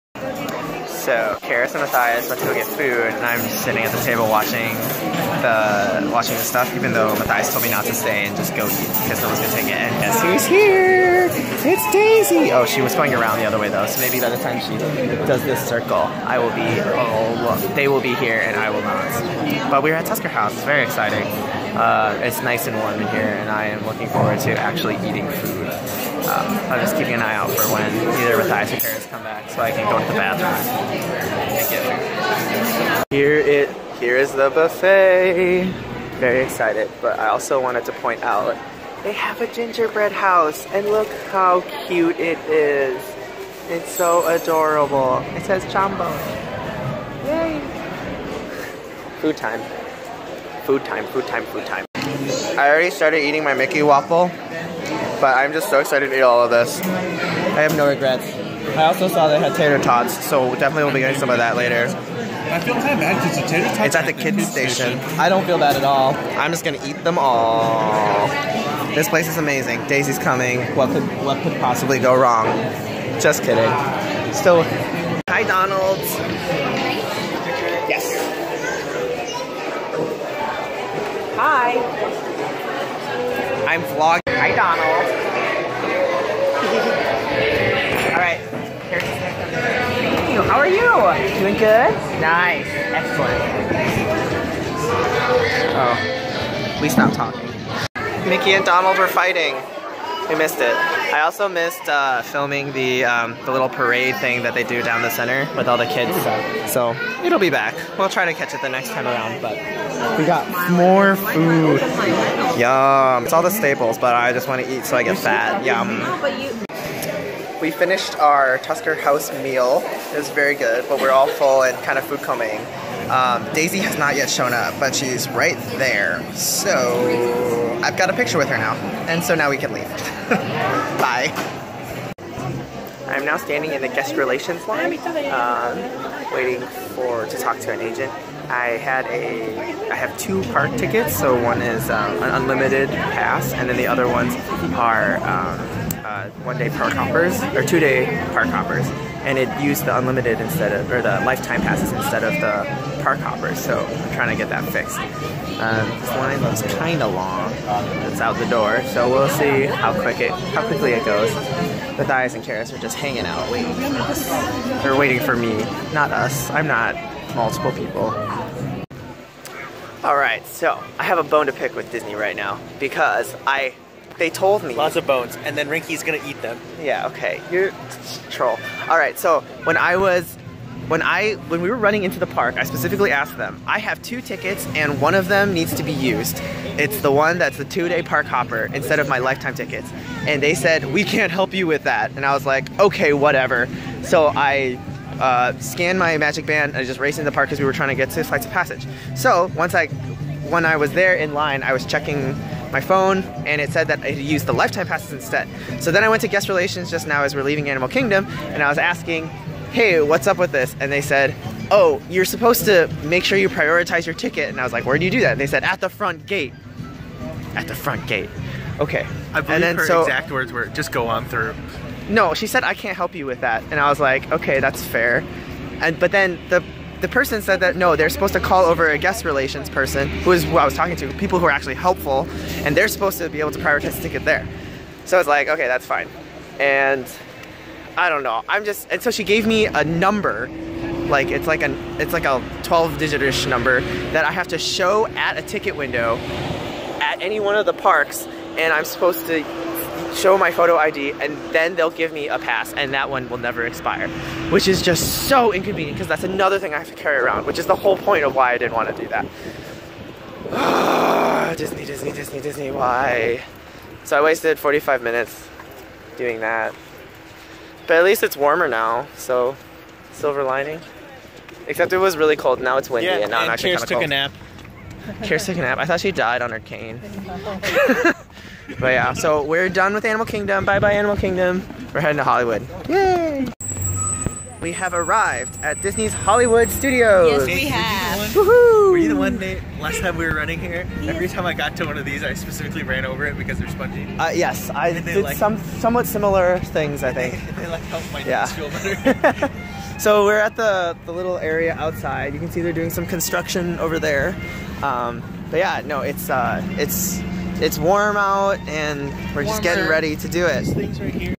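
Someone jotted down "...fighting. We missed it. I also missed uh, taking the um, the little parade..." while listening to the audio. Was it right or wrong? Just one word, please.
wrong.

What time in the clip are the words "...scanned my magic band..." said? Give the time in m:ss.
3:15.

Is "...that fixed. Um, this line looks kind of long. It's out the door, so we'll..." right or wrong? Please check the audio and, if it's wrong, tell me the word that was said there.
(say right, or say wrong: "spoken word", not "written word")
right.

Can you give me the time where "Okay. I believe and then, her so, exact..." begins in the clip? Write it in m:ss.
3:38.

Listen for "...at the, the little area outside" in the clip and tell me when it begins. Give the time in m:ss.
5:00.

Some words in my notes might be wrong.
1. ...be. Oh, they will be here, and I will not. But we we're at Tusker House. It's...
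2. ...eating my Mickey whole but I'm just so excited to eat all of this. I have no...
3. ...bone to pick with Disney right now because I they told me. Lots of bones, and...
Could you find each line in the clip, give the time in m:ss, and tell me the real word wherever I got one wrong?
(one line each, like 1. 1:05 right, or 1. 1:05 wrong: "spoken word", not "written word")
1. 0:16 right
2. 0:53 wrong: "waffle", not "whole"
3. 2:51 right.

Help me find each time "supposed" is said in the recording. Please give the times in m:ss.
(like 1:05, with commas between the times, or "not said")
3:32, 3:48, 3:52, 4:08.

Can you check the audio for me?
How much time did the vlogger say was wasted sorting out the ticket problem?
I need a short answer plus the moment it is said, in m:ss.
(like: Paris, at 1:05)
45 minutes, at 4:24.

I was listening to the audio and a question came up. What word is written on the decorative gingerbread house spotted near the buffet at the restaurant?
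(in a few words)
Jambo.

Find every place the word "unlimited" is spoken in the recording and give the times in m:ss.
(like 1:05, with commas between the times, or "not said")
2:22, 2:29.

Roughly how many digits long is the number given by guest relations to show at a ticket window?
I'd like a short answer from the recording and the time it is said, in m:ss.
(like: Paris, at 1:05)
12, at 4:02.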